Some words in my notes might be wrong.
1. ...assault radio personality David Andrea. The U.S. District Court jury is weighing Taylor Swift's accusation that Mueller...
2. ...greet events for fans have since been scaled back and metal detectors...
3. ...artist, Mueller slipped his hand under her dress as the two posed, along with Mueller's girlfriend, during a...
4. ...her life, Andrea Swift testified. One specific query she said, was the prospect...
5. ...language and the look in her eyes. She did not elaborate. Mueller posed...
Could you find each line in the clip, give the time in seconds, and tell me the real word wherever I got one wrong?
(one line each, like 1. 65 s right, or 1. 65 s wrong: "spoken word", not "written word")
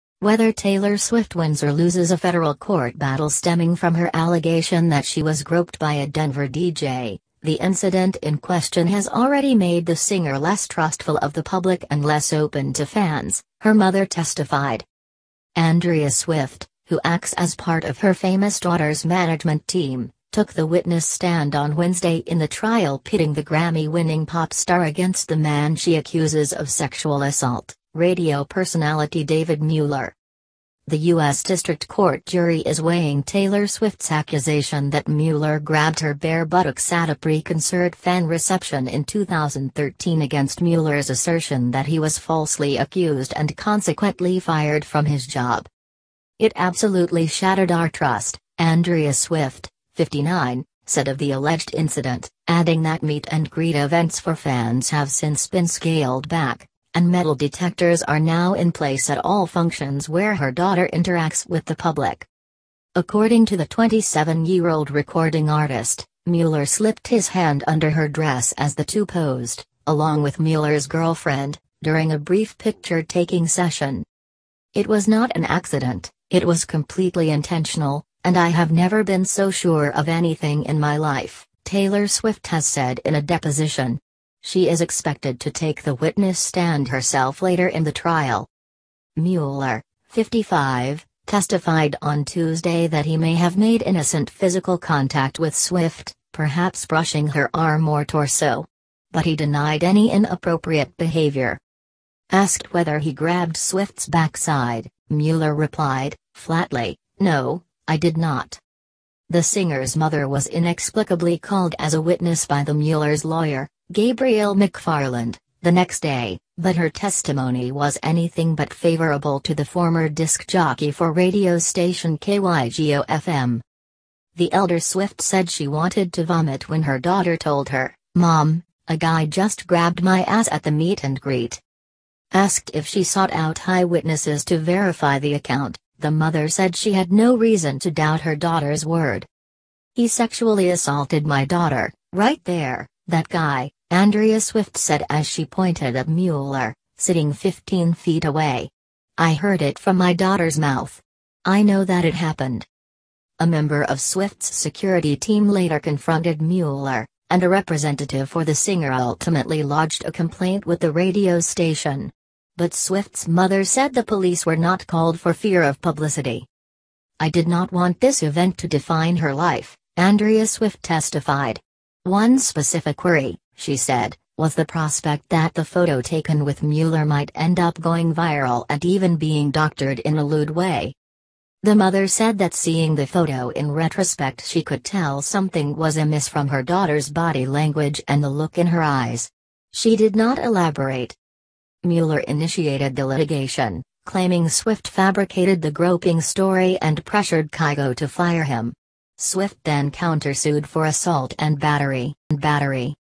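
1. 27 s wrong: "Mueller", not "Andrea"
2. 53 s right
3. 65 s right
4. 169 s right
5. 187 s wrong: "initiated", not "posed".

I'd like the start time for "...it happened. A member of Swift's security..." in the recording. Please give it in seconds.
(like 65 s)
152 s.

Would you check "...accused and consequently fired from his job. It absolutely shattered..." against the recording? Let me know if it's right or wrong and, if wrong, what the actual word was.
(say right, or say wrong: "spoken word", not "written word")
right.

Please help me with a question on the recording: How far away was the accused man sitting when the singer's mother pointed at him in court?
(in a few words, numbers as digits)
15 feet.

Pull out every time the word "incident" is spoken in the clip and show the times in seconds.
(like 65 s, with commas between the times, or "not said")
7 s, 51 s.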